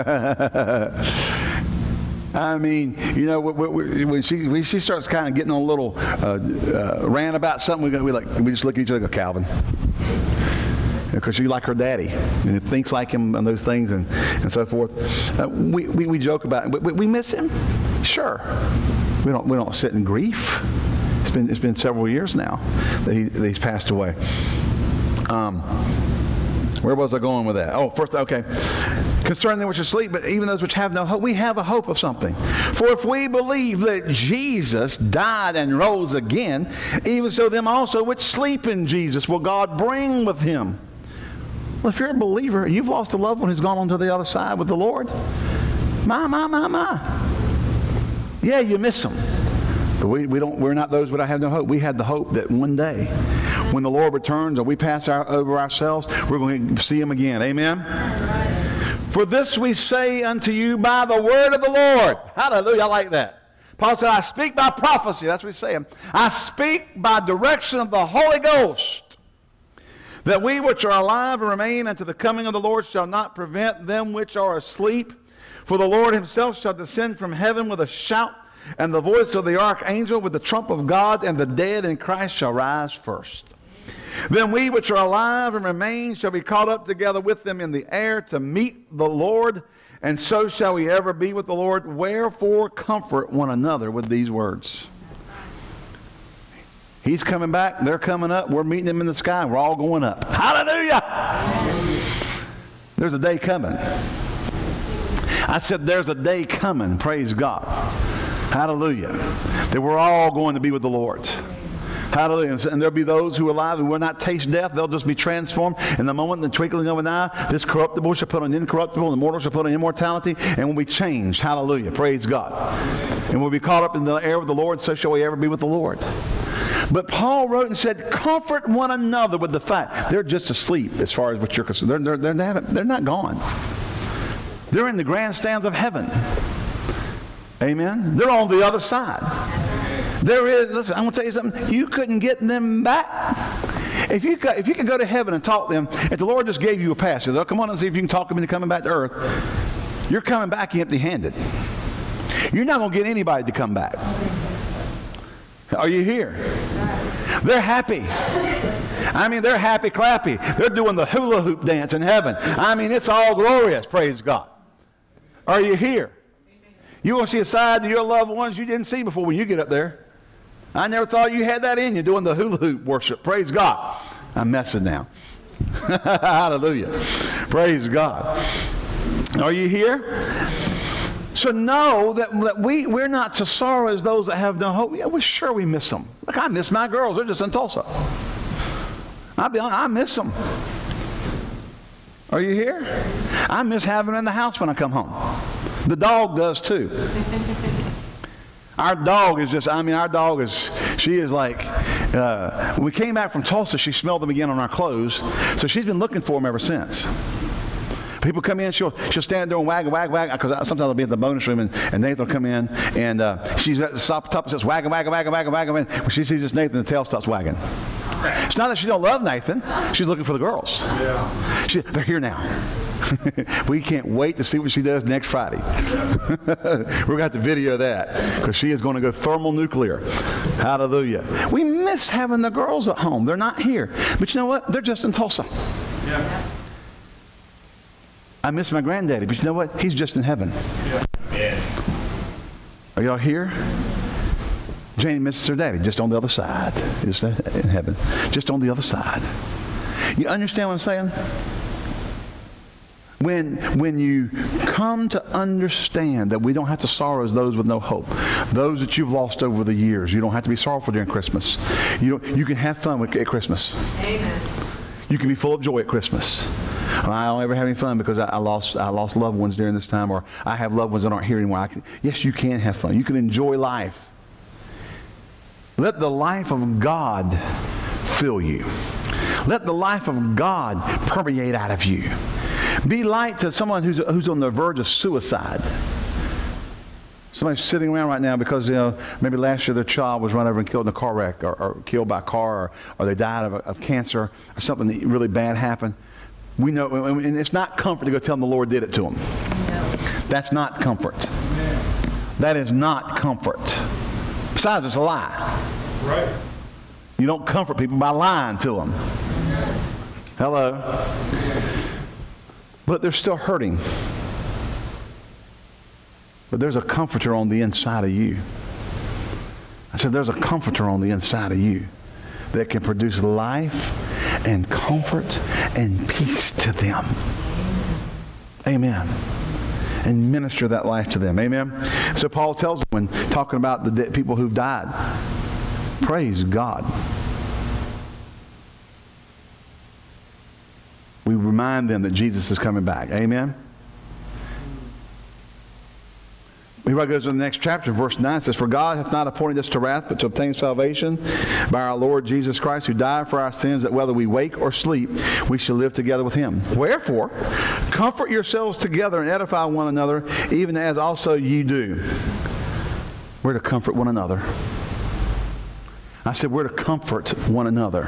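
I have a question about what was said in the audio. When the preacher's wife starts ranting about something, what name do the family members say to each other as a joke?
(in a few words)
Calvin.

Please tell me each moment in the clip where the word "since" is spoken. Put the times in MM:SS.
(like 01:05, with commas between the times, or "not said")
03:26.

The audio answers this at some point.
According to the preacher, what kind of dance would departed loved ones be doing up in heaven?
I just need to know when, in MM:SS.
02:41.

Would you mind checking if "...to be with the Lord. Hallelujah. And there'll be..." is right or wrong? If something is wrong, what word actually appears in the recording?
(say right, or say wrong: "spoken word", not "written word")
right.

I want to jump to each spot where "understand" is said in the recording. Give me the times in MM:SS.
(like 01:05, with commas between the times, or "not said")
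04:10, 04:15.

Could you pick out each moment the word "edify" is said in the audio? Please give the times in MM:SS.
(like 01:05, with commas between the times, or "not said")
05:59.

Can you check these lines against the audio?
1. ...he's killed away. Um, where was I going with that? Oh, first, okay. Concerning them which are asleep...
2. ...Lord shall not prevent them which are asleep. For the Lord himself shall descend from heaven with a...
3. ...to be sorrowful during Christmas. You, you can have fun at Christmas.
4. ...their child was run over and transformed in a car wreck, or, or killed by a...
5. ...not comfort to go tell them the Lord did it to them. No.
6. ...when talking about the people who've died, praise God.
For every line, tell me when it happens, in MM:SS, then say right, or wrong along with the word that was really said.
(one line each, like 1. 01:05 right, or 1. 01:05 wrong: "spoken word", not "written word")
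1. 00:23 wrong: "passed", not "killed"
2. 01:12 right
3. 04:20 right
4. 04:49 wrong: "killed", not "transformed"
5. 04:57 right
6. 05:32 right.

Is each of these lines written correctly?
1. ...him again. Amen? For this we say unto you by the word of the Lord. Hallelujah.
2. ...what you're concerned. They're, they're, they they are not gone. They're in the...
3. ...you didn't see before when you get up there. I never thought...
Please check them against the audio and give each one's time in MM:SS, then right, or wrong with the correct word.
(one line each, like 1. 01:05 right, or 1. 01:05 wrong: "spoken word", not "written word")
1. 00:56 right
2. 02:11 right
3. 02:48 right.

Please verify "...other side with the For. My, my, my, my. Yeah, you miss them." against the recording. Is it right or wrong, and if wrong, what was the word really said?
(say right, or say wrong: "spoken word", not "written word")
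wrong: "Lord", not "For".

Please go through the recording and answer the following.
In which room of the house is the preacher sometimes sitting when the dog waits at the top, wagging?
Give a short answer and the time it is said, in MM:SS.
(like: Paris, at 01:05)
bonus room, at 03:31.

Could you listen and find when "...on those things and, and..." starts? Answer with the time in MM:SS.
00:13.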